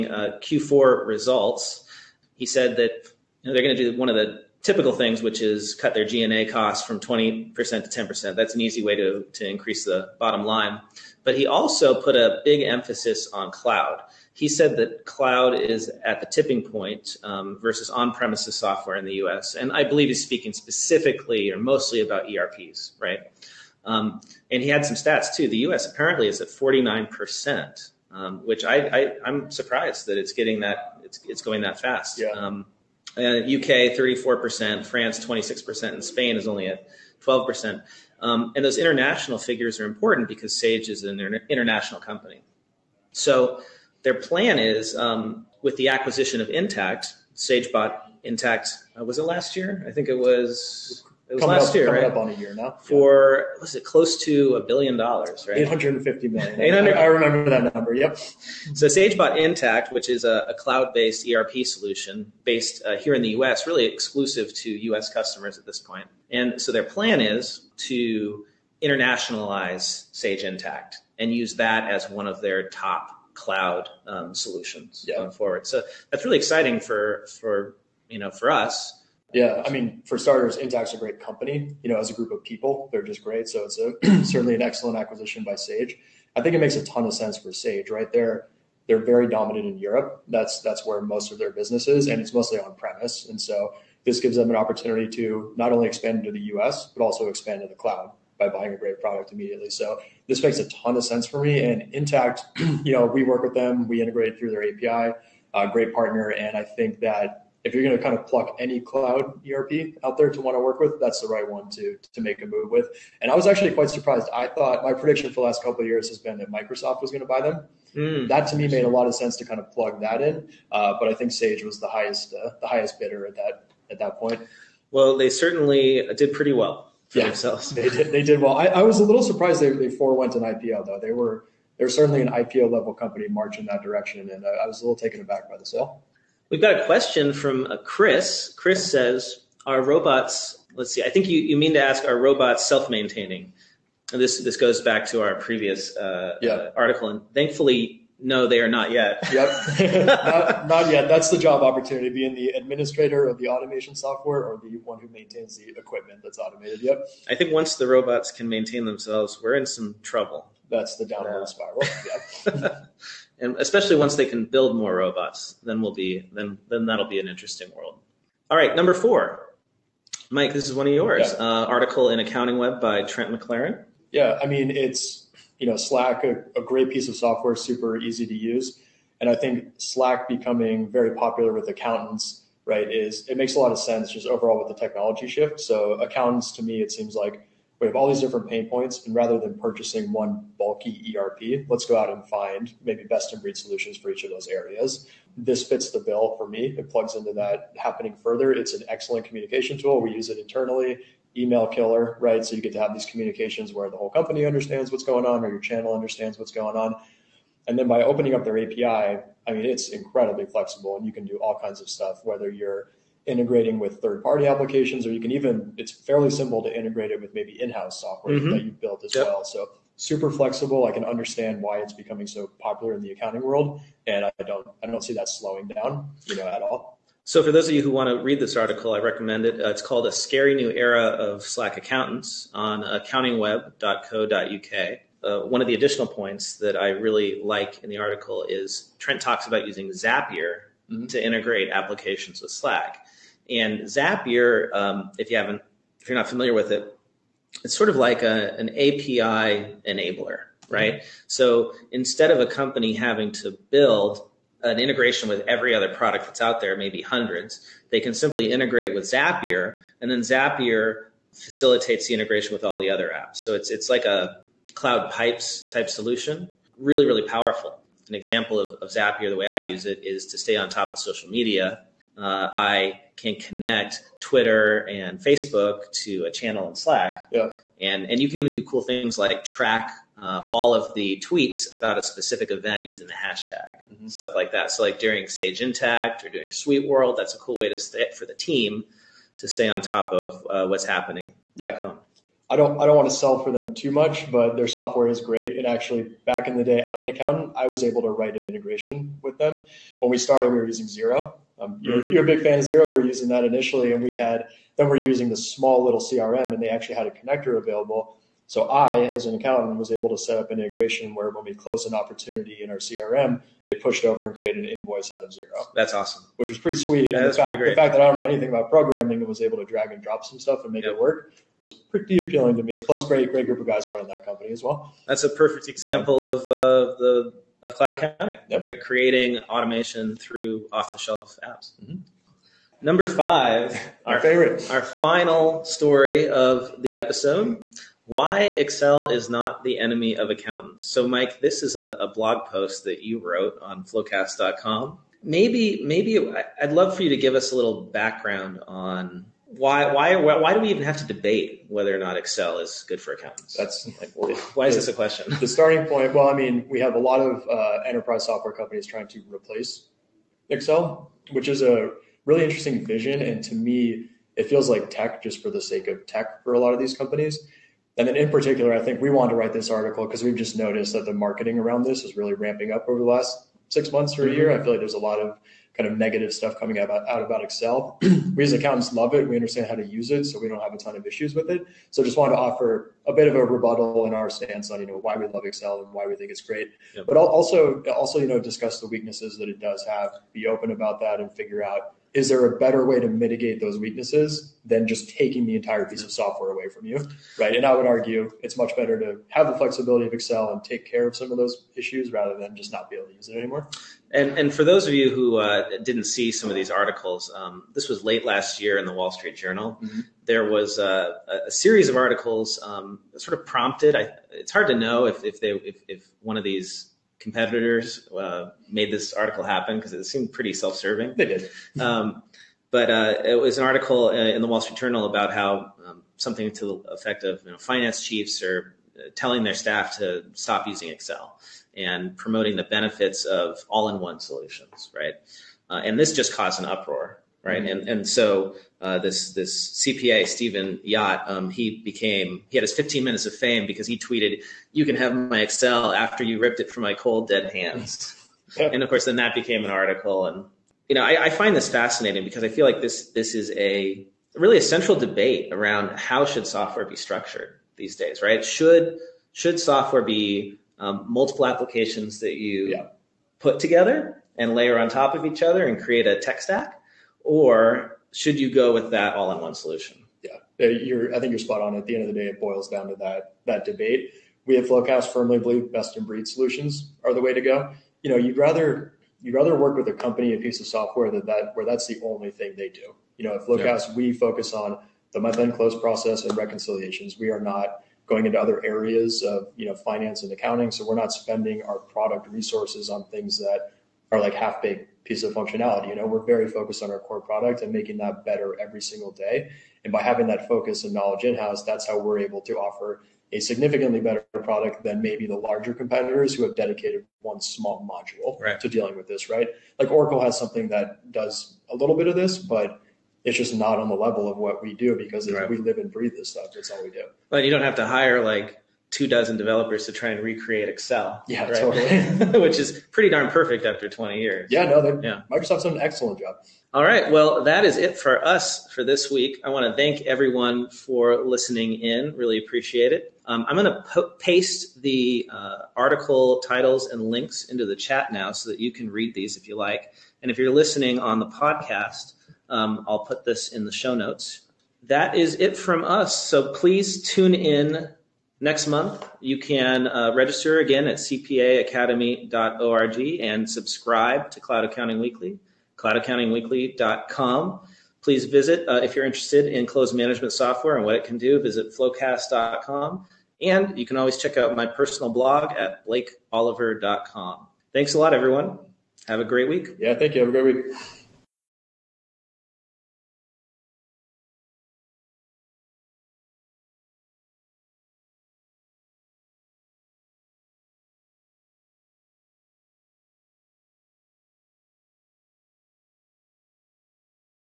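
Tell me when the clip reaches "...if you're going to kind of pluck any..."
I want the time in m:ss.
1:47.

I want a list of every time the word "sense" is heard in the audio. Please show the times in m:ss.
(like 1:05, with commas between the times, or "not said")
1:27, 1:41, 1:59, 3:03.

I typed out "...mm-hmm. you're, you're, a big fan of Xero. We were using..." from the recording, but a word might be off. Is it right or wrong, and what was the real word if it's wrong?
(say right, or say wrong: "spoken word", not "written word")
right.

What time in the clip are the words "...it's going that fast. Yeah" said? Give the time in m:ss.
0:31.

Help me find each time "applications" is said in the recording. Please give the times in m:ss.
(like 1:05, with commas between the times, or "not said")
3:34, 4:01, 7:41.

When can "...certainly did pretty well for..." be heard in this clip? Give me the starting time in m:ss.
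2:05.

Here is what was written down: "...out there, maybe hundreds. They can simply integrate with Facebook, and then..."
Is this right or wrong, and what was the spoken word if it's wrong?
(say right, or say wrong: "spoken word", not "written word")
wrong: "Zapier", not "Facebook".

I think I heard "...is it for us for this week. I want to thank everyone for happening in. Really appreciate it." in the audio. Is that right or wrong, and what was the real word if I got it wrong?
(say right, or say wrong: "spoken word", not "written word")
wrong: "listening", not "happening".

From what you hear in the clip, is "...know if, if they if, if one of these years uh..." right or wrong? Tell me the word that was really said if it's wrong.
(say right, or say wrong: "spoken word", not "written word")
wrong: "competitors", not "years".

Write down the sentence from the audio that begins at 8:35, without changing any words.
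we live and breathe this stuff.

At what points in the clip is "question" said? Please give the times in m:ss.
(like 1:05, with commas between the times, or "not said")
2:16, 5:54.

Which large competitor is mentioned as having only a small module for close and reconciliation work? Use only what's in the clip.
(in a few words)
Oracle.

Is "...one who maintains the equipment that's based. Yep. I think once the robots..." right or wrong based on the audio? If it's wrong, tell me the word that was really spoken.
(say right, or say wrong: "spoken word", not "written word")
wrong: "automated", not "based".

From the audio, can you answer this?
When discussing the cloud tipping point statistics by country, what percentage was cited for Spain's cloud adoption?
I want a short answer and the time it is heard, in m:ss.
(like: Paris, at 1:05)
12%, at 0:37.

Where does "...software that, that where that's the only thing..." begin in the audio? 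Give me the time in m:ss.
8:00.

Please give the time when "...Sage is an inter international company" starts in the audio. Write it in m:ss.
0:40.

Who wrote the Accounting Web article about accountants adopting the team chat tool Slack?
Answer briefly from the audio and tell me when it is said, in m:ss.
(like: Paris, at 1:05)
Trent McLaren, at 2:53.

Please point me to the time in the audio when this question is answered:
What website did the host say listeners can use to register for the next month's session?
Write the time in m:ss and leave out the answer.
9:10.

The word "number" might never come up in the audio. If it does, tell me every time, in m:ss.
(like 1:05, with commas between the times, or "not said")
0:57, 2:48, 5:32.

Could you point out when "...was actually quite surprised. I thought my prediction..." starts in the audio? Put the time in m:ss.
1:53.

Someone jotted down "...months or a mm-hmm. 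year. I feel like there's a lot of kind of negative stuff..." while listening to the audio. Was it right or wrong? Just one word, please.
right.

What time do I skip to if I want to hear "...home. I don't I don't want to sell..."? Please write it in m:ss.
4:51.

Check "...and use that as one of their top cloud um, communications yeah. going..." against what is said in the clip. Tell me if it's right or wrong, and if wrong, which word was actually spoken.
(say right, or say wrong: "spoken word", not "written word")
wrong: "solutions", not "communications".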